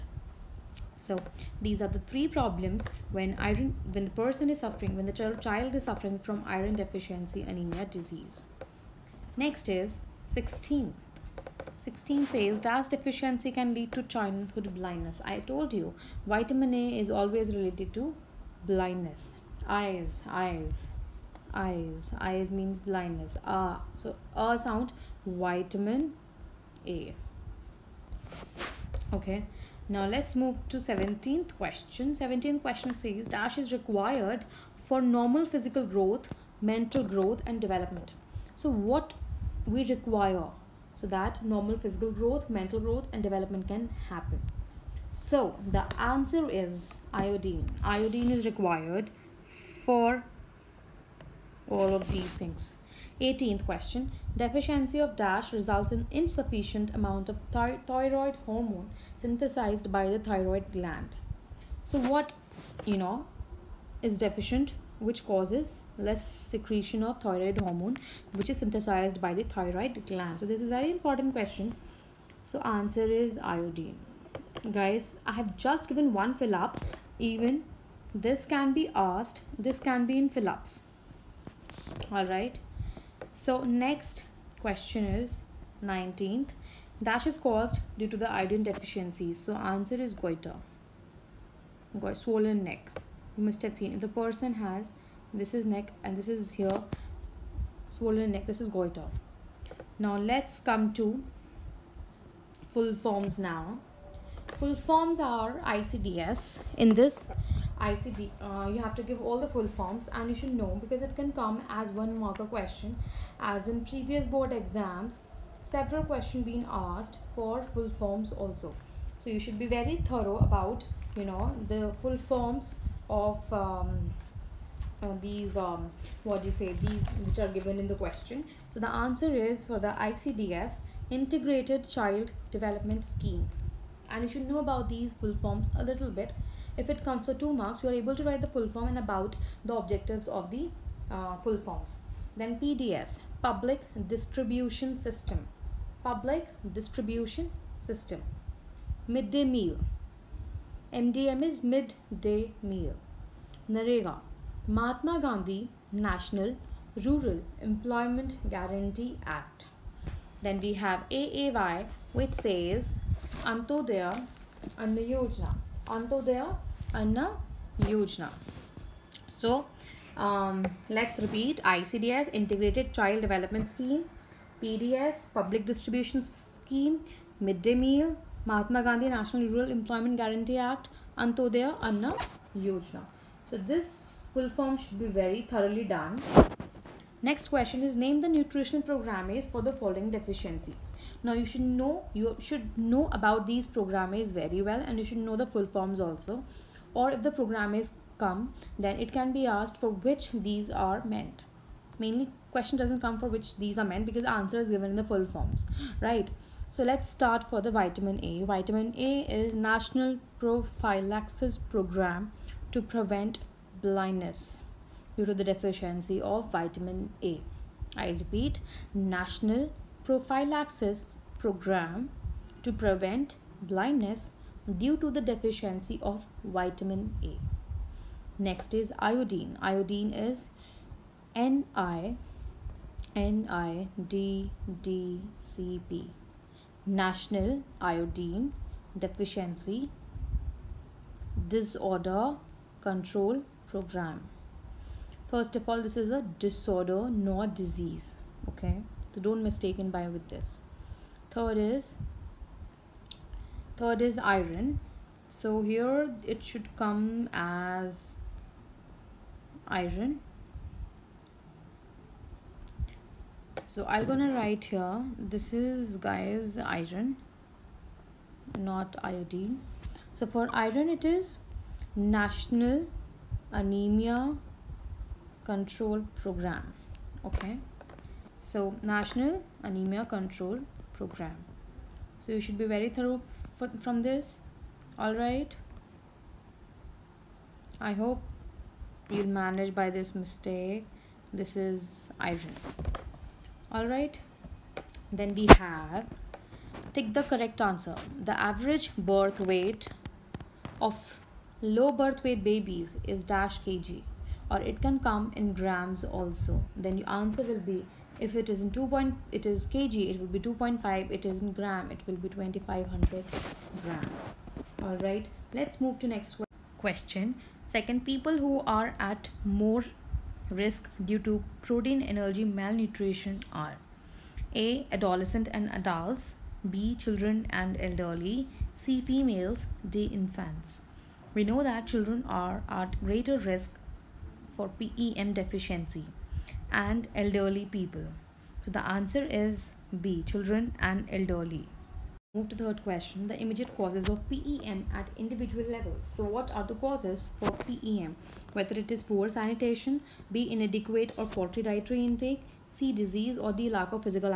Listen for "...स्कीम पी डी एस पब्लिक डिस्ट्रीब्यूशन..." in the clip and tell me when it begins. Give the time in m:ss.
2:53.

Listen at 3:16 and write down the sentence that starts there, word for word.
Or if the programmes come then it can be asked for which these are meant.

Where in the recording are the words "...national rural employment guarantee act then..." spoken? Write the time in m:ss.
2:36.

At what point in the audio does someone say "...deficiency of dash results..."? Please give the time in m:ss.
0:54.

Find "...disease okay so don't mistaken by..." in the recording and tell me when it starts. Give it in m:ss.
4:07.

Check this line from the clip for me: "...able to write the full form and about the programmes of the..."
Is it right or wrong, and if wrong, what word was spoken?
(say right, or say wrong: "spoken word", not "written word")
wrong: "objectives", not "programmes".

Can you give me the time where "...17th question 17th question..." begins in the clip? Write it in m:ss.
0:30.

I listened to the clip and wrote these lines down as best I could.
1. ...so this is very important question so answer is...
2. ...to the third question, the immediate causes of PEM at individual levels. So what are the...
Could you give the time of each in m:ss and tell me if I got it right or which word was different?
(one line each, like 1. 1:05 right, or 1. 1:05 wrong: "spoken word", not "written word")
1. 1:10 right
2. 5:42 right.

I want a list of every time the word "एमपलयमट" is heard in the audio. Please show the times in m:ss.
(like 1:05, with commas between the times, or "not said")
2:59.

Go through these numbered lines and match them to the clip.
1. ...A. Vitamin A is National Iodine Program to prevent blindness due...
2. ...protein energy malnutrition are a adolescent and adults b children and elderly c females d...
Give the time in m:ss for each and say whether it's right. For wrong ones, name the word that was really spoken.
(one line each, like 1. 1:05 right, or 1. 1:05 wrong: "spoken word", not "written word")
1. 3:28 wrong: "Prophylaxis", not "Iodine"
2. 5:21 right.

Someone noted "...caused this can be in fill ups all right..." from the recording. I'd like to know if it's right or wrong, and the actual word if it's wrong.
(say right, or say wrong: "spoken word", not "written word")
wrong: "asked", not "caused".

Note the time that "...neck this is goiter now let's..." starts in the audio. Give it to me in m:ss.
1:38.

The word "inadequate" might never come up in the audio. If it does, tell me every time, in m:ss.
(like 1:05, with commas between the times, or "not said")
5:50.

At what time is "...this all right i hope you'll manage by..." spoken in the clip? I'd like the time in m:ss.
4:44.